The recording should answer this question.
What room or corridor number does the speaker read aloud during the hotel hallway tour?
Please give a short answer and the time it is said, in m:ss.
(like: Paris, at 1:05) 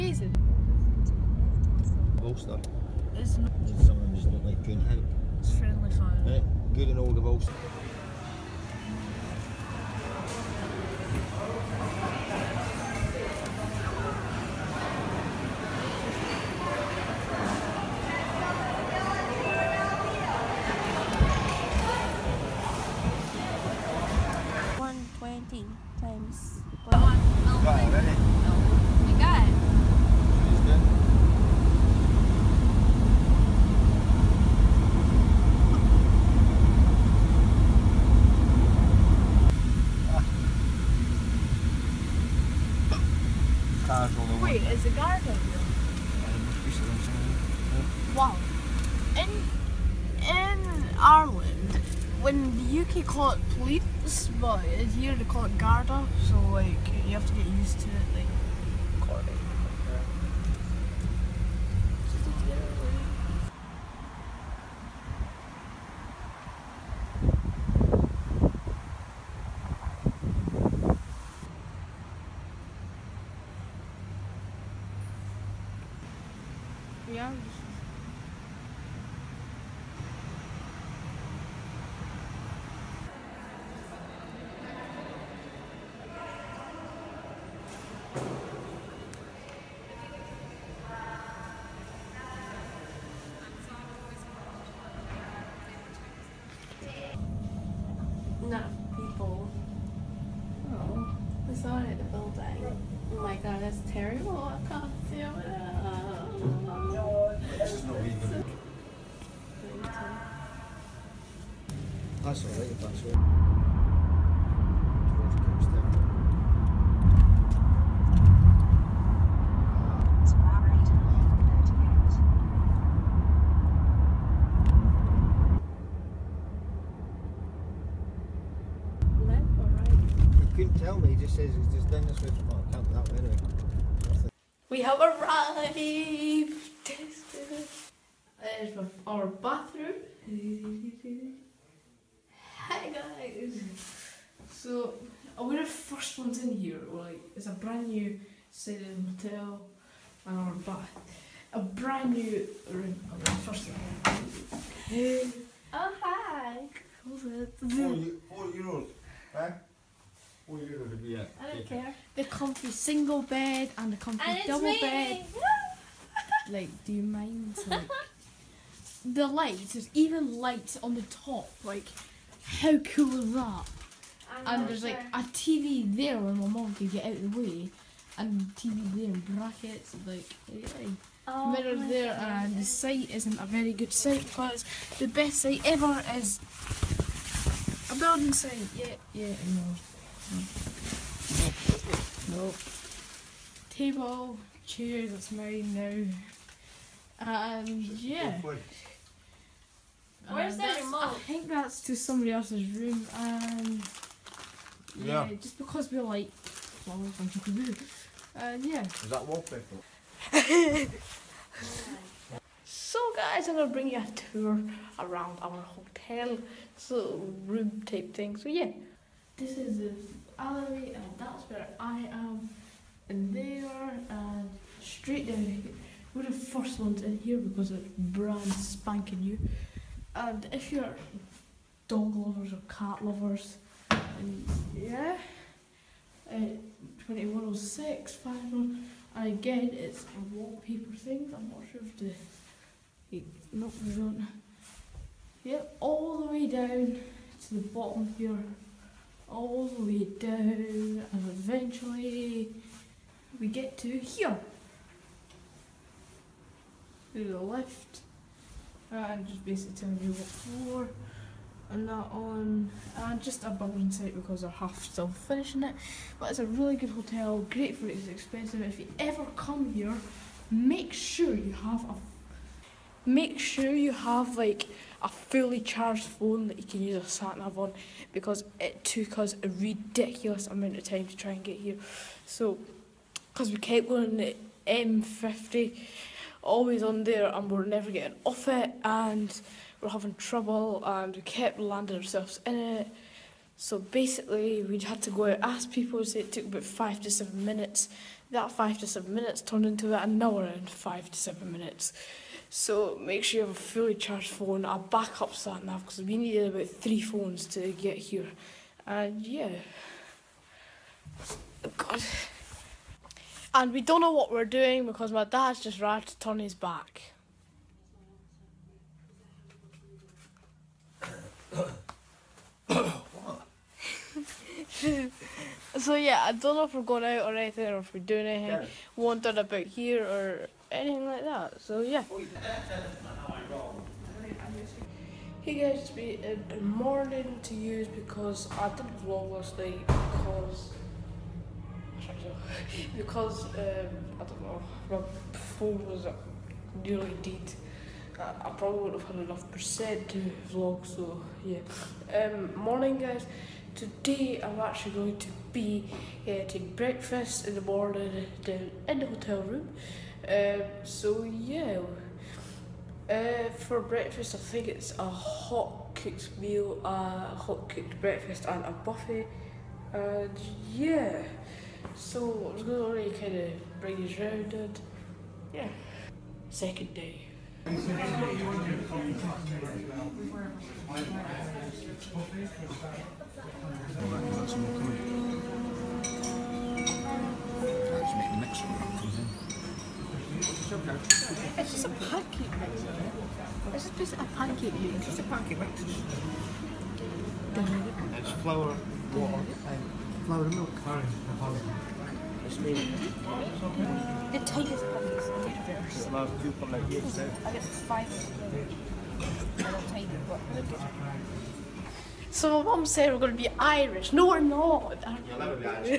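2106, at 3:57.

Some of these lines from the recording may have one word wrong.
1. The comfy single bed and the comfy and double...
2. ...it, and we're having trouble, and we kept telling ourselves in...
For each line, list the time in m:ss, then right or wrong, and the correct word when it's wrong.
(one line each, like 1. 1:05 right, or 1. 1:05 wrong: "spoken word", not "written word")
1. 2:42 right
2. 4:48 wrong: "landing", not "telling".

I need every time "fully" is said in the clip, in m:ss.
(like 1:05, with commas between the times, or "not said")
4:35, 5:03.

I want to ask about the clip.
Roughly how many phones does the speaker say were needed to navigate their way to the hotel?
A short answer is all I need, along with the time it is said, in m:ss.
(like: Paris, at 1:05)
3, at 5:06.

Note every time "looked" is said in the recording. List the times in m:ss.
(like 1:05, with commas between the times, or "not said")
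0:04.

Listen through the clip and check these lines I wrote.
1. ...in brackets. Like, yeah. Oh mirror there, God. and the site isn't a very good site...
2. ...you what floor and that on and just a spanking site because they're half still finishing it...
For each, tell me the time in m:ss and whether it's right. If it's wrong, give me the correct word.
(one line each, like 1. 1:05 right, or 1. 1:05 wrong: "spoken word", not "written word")
1. 2:59 right
2. 4:20 wrong: "building", not "spanking".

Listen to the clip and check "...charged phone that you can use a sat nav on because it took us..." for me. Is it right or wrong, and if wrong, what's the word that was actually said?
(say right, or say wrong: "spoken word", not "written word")
right.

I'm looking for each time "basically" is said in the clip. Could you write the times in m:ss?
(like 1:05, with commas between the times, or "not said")
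4:19, 4:53.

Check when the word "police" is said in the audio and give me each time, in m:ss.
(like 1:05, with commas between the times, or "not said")
0:53.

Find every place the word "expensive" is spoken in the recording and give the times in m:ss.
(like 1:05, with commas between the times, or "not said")
4:28.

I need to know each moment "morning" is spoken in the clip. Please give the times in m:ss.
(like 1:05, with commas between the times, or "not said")
5:36, 5:52, 5:57.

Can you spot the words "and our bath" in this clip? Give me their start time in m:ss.
2:30.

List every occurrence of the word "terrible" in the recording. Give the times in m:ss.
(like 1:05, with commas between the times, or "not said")
1:43.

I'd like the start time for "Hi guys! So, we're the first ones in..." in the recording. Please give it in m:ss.
2:22.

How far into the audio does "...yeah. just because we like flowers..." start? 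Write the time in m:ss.
3:25.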